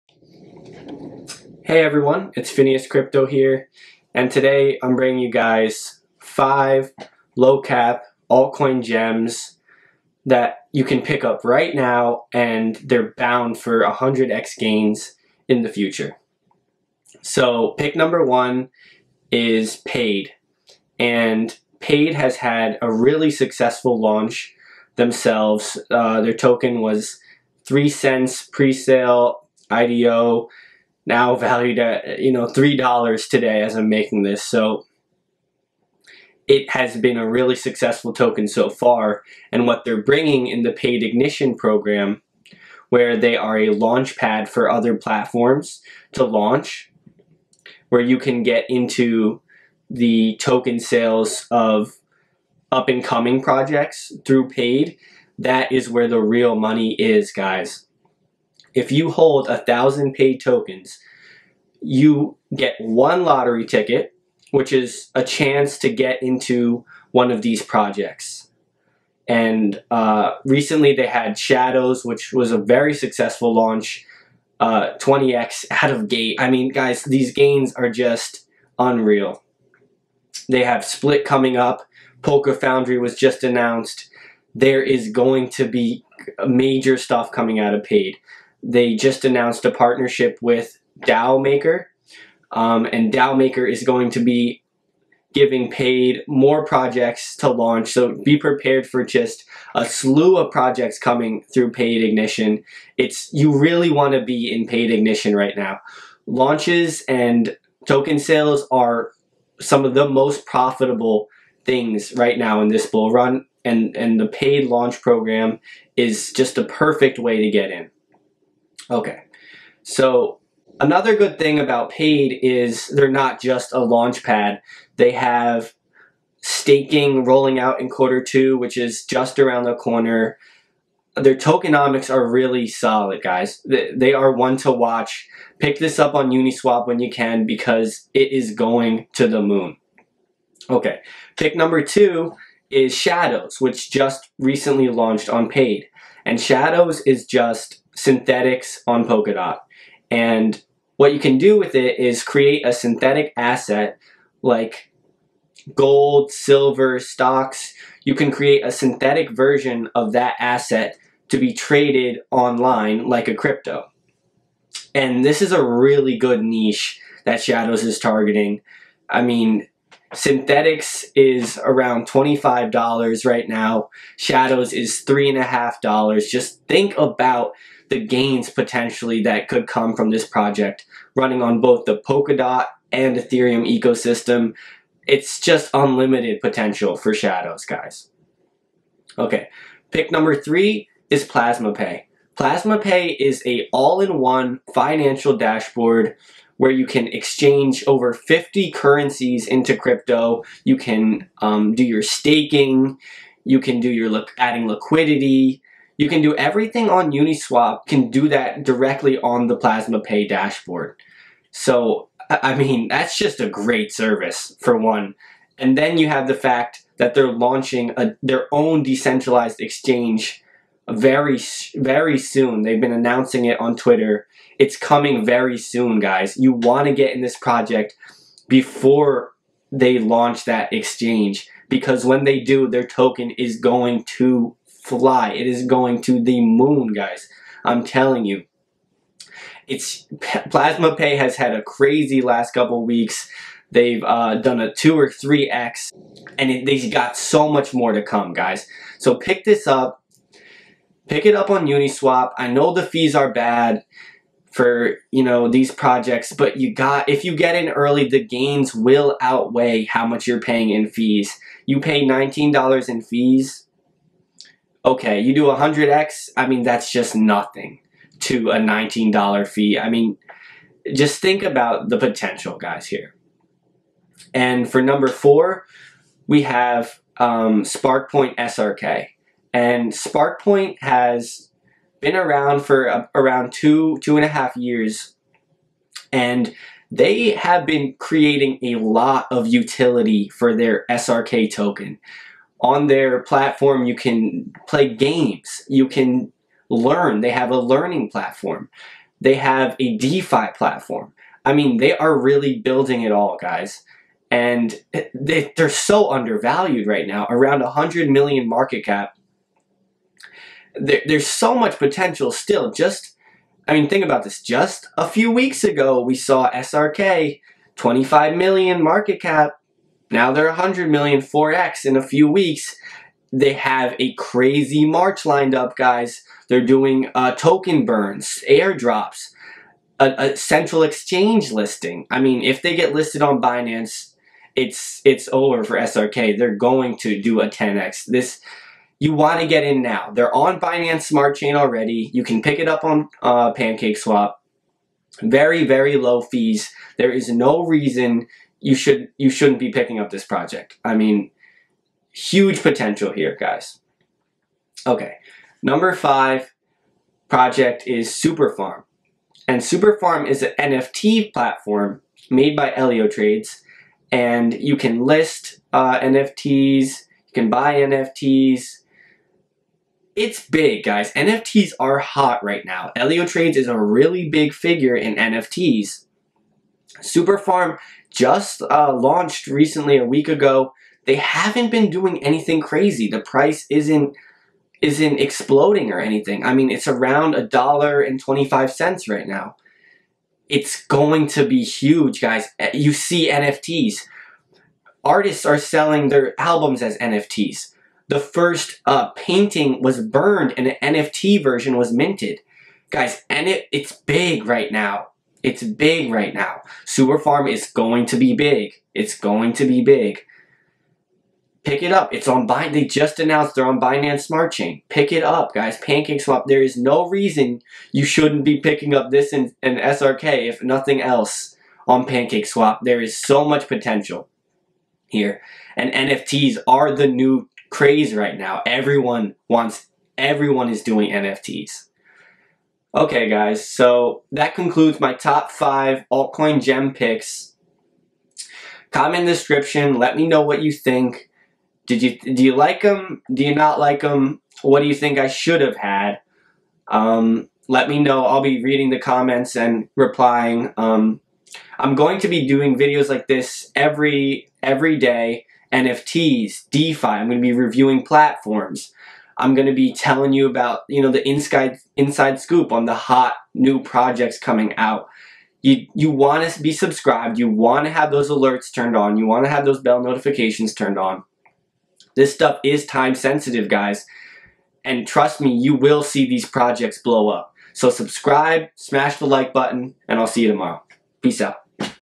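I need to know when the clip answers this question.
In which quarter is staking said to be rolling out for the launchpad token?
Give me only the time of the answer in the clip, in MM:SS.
02:07.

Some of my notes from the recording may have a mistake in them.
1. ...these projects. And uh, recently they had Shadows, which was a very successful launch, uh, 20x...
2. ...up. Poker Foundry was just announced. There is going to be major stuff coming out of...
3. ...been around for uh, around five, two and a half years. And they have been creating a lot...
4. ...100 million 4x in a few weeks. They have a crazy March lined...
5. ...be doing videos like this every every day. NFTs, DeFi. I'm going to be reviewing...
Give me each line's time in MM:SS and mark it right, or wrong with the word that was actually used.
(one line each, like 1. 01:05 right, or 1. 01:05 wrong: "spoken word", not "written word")
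1. 01:07 right
2. 01:21 right
3. 04:41 wrong: "two", not "five"
4. 05:20 right
5. 07:32 right.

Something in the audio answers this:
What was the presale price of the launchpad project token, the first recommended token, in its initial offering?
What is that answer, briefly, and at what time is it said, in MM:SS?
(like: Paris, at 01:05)
3 cents, at 00:27.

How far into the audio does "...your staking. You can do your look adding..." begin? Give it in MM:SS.
03:21.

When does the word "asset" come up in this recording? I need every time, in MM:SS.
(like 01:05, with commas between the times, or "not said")
02:33, 02:40.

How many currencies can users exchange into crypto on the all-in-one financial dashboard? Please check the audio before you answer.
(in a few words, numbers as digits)
Over 50.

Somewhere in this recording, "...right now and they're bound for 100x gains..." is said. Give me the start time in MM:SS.
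00:11.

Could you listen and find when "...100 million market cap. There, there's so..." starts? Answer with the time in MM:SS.
05:07.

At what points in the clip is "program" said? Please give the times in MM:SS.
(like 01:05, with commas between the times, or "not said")
00:41, 01:55.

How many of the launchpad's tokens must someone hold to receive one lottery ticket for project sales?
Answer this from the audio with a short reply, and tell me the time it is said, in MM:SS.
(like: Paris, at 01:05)
1,000, at 00:59.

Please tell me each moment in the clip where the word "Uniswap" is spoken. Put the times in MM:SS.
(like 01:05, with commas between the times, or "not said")
02:16, 03:27, 04:11.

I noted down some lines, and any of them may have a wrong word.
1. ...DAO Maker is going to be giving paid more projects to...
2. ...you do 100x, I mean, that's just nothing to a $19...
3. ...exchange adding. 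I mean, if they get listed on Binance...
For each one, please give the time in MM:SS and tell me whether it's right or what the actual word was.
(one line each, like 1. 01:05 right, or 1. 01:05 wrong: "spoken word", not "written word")
1. 01:33 right
2. 04:25 right
3. 05:30 wrong: "listing", not "adding".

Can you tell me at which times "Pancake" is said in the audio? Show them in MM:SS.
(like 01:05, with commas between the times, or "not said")
05:43, 06:55, 07:02.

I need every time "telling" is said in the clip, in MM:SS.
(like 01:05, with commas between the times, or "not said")
03:57, 07:39.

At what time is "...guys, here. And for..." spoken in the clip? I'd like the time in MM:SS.
04:32.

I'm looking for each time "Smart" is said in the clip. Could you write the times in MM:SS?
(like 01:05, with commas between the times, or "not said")
05:41, 06:54.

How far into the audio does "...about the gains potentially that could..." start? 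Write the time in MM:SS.
02:56.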